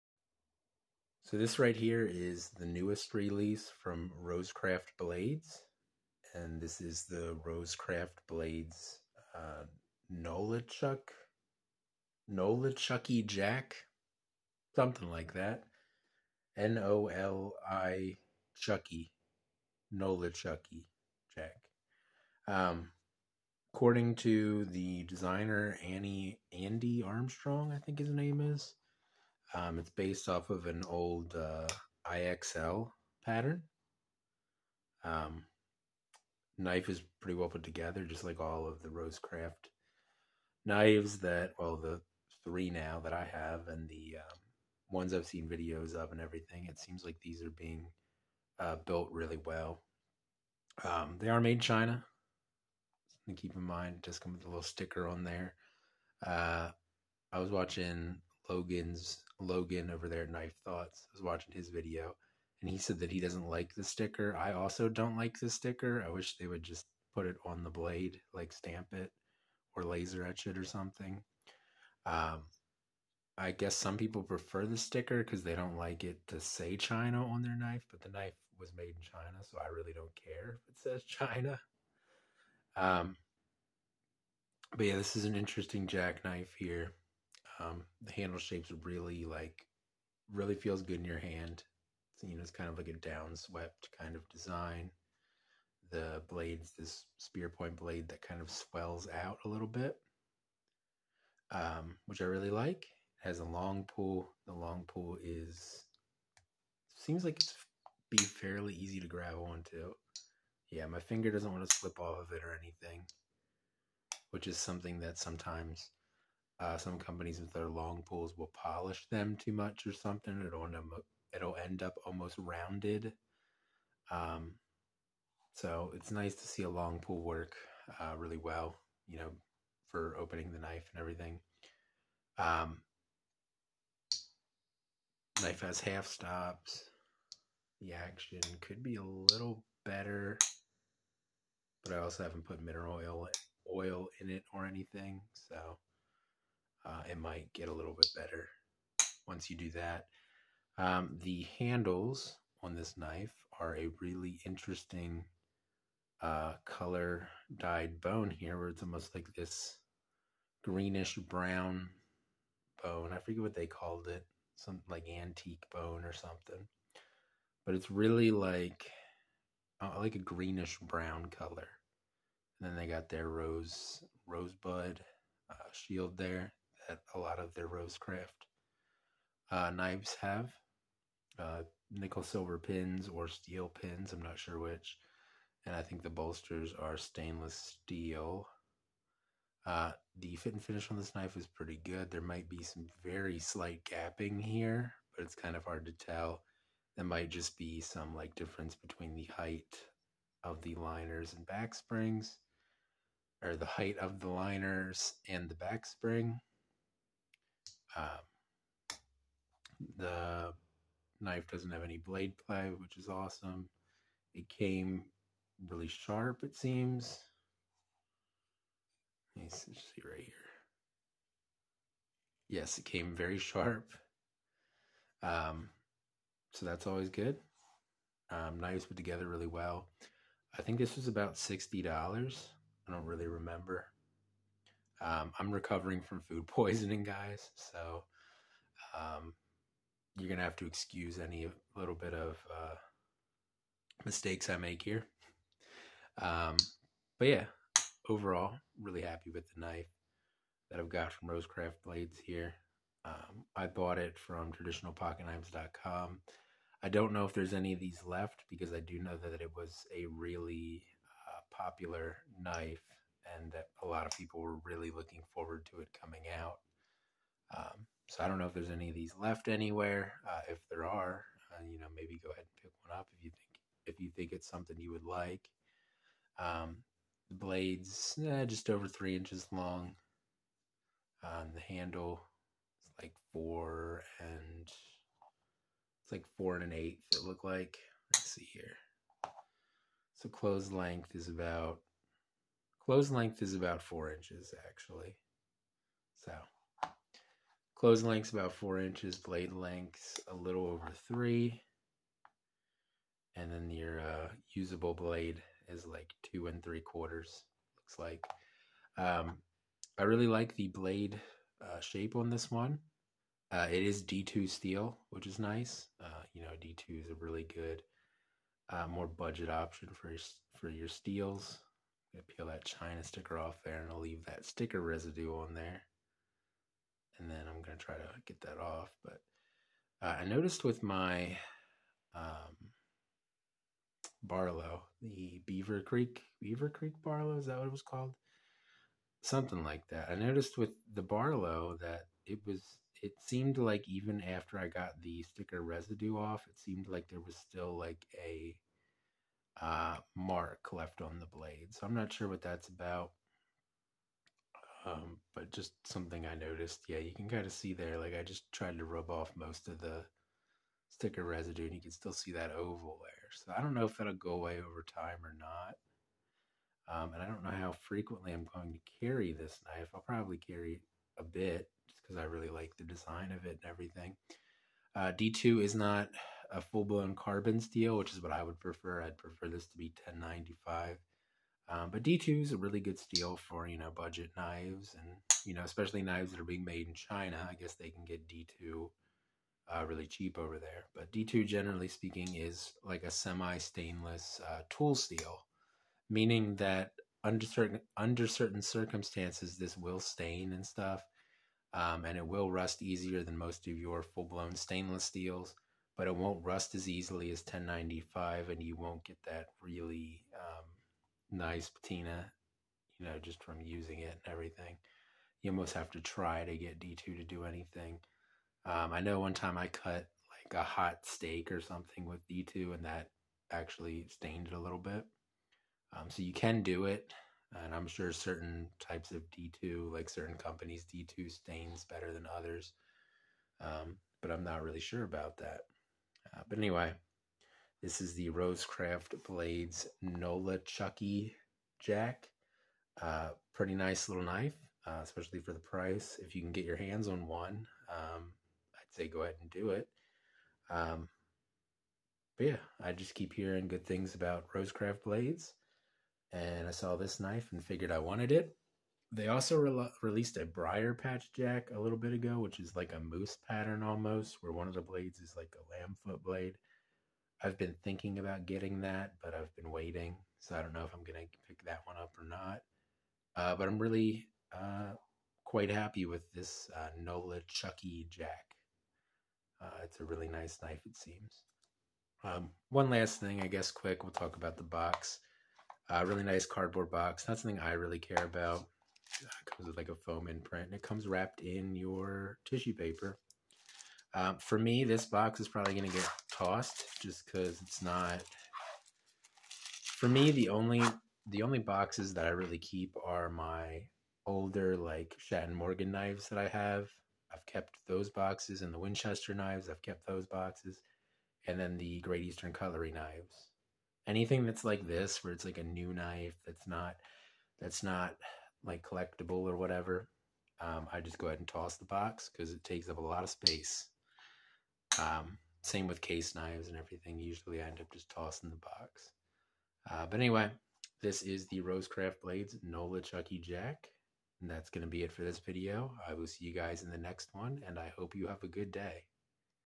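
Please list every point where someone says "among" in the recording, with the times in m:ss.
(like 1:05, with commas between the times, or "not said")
not said.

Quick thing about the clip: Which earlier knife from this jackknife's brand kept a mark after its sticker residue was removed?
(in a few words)
Beaver Creek Barlow.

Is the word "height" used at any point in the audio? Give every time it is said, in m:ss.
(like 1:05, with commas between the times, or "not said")
3:19, 3:23.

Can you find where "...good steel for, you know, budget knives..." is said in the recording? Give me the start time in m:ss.
6:22.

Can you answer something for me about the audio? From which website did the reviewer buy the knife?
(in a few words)
traditionalpocketknives.com.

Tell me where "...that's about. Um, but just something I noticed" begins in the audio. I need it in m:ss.
5:52.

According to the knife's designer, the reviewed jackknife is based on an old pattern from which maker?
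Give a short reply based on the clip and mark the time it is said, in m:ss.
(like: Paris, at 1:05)
IXL, at 0:32.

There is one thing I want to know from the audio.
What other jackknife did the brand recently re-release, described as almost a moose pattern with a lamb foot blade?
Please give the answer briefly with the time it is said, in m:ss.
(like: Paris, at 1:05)
Briar Patch Jack, at 7:40.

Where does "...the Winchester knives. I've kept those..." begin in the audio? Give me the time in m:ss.
8:28.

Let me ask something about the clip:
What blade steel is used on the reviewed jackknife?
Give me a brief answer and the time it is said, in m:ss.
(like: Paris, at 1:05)
D2, at 5:14.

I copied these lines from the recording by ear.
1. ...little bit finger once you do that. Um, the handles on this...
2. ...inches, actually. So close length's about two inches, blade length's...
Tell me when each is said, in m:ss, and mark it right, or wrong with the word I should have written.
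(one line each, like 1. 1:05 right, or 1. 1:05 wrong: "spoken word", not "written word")
1. 2:27 wrong: "better", not "finger"
2. 4:54 wrong: "four", not "two".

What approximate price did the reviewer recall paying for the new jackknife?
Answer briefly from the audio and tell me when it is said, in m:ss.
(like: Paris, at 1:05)
$60, at 3:51.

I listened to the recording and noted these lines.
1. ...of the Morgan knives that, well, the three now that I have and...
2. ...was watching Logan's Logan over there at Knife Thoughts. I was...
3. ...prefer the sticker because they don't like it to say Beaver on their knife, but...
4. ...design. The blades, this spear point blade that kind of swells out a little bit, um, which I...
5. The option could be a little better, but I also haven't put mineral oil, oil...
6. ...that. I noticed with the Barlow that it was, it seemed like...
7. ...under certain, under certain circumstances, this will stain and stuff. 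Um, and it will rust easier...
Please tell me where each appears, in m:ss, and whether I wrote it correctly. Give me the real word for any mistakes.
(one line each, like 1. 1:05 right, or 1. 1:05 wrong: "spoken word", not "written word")
1. 0:38 wrong: "Rosecraft", not "Morgan"
2. 0:57 right
3. 1:14 wrong: "China", not "Beaver"
4. 1:34 right
5. 2:17 wrong: "action", not "option"
6. 5:39 right
7. 6:37 right.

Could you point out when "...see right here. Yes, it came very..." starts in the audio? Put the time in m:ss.
3:39.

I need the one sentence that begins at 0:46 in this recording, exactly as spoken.
It seems like these are being uh, built really well.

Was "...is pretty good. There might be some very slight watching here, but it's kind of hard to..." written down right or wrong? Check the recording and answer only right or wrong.
wrong.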